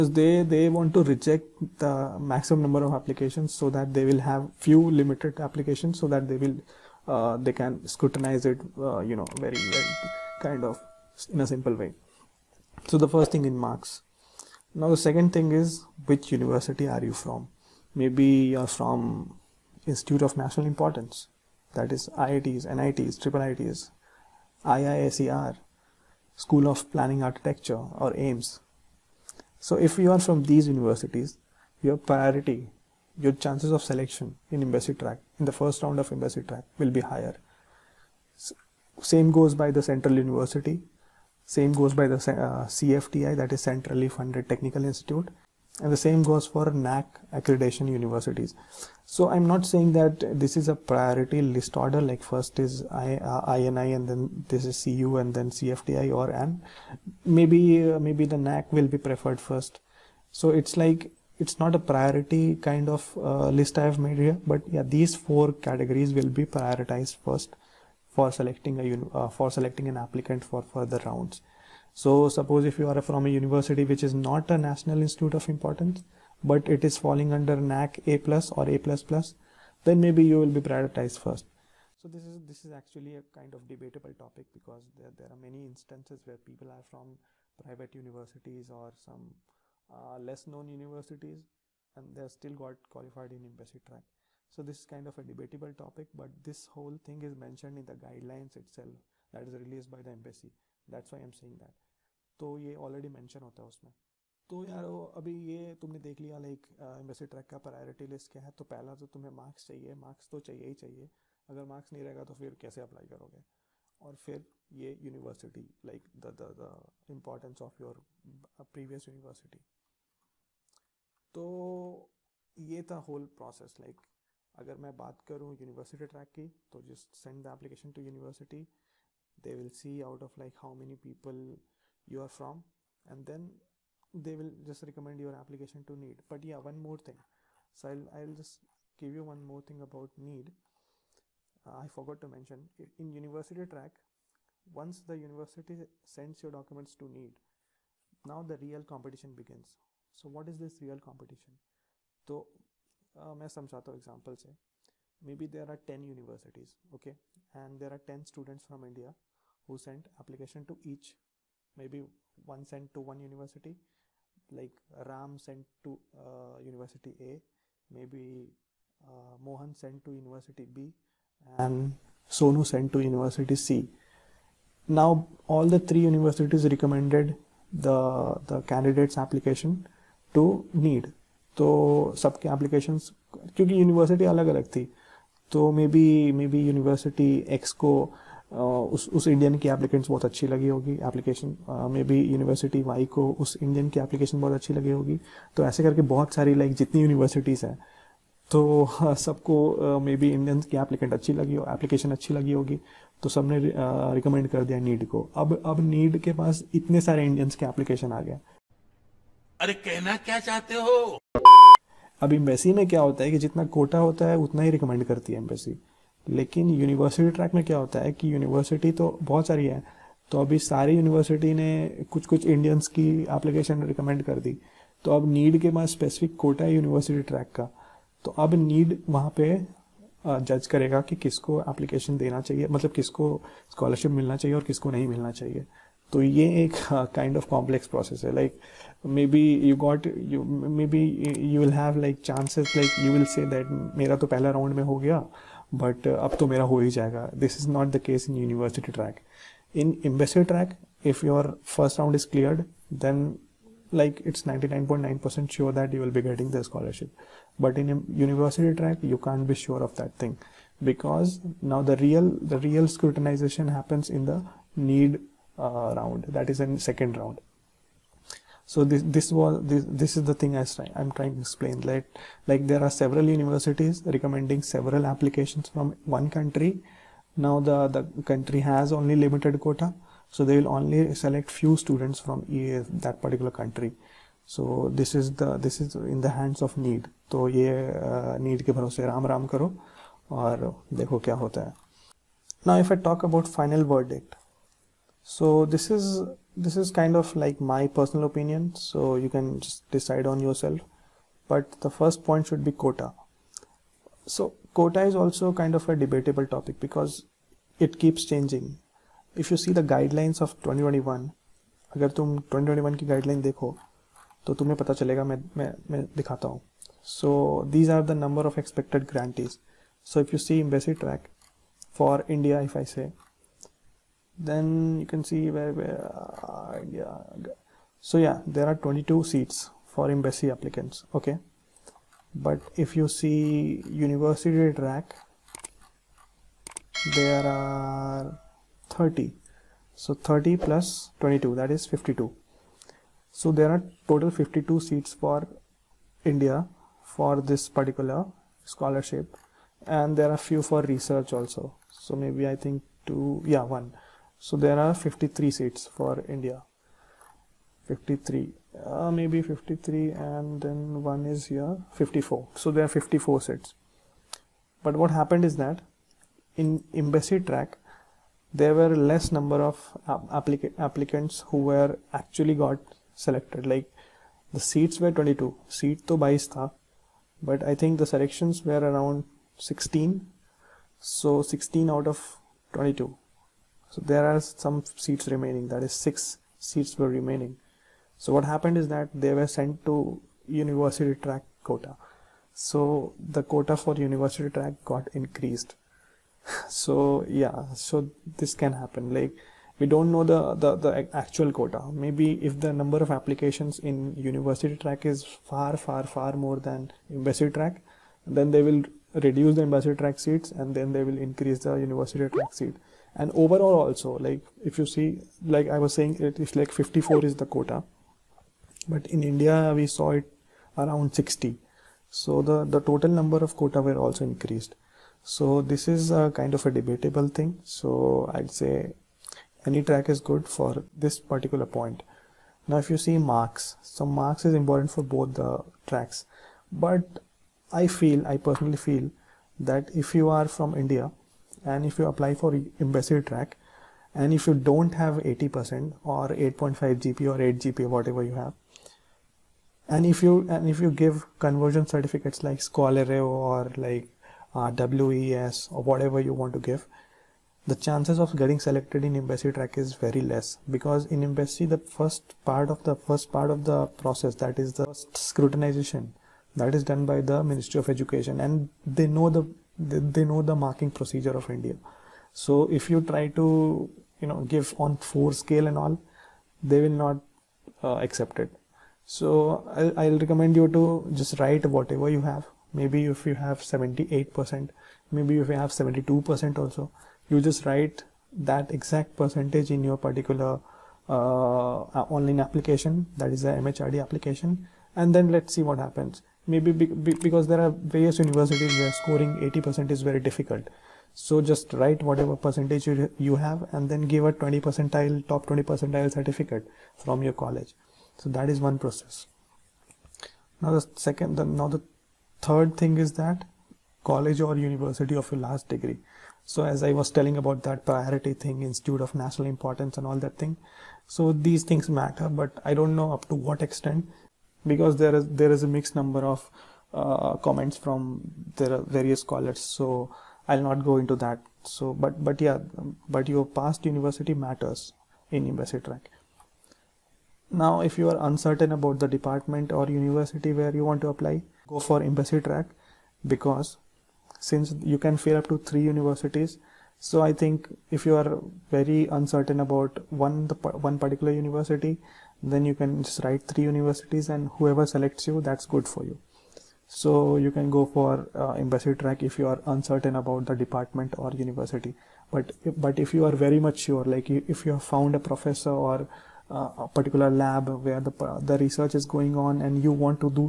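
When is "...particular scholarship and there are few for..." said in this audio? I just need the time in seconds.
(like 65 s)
347 s.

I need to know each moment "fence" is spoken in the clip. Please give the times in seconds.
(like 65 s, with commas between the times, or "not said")
not said.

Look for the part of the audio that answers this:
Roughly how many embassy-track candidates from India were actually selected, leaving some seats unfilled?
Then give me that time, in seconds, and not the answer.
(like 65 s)
378 s.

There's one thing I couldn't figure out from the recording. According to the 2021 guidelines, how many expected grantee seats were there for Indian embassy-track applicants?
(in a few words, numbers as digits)
22.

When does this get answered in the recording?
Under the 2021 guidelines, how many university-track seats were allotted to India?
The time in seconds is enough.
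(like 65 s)
337 s.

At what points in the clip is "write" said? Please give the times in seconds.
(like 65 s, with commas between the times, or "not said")
481 s, 487 s, 501 s, 553 s.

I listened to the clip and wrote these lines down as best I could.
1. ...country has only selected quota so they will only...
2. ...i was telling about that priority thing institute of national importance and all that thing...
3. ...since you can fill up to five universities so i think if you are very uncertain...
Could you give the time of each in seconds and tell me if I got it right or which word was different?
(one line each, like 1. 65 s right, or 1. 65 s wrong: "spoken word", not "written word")
1. 278 s wrong: "limited", not "selected"
2. 516 s right
3. 544 s wrong: "three", not "five".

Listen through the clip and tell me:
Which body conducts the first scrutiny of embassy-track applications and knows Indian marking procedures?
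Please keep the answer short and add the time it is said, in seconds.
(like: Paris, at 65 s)
Ministry of Education, at 467 s.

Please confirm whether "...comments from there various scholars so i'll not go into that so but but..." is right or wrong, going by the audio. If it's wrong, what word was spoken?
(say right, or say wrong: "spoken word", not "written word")
right.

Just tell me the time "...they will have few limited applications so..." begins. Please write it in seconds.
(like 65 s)
3 s.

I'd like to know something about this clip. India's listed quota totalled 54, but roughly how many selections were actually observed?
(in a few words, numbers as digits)
60.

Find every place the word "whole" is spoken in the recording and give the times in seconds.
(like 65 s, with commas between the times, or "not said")
96 s.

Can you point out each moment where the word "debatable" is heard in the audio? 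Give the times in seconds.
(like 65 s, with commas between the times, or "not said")
83 s, 95 s, 305 s, 426 s.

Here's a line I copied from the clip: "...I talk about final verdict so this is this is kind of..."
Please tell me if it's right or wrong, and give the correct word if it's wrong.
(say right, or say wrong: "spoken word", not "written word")
right.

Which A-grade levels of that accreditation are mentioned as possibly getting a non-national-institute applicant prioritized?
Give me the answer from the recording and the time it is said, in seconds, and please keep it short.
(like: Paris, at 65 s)
A plus or A plus plus, at 78 s.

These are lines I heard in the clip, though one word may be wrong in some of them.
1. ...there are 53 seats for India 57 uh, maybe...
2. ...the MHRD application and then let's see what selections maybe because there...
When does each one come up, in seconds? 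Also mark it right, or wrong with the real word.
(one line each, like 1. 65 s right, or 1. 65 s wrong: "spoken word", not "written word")
1. 354 s wrong: "53", not "57"
2. 493 s wrong: "happens", not "selections".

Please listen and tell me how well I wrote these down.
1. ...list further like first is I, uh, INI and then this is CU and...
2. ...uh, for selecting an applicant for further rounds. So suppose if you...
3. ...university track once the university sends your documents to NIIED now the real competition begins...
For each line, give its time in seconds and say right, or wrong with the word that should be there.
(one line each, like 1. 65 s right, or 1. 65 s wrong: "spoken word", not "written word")
1. 51 s wrong: "order", not "further"
2. 69 s right
3. 143 s right.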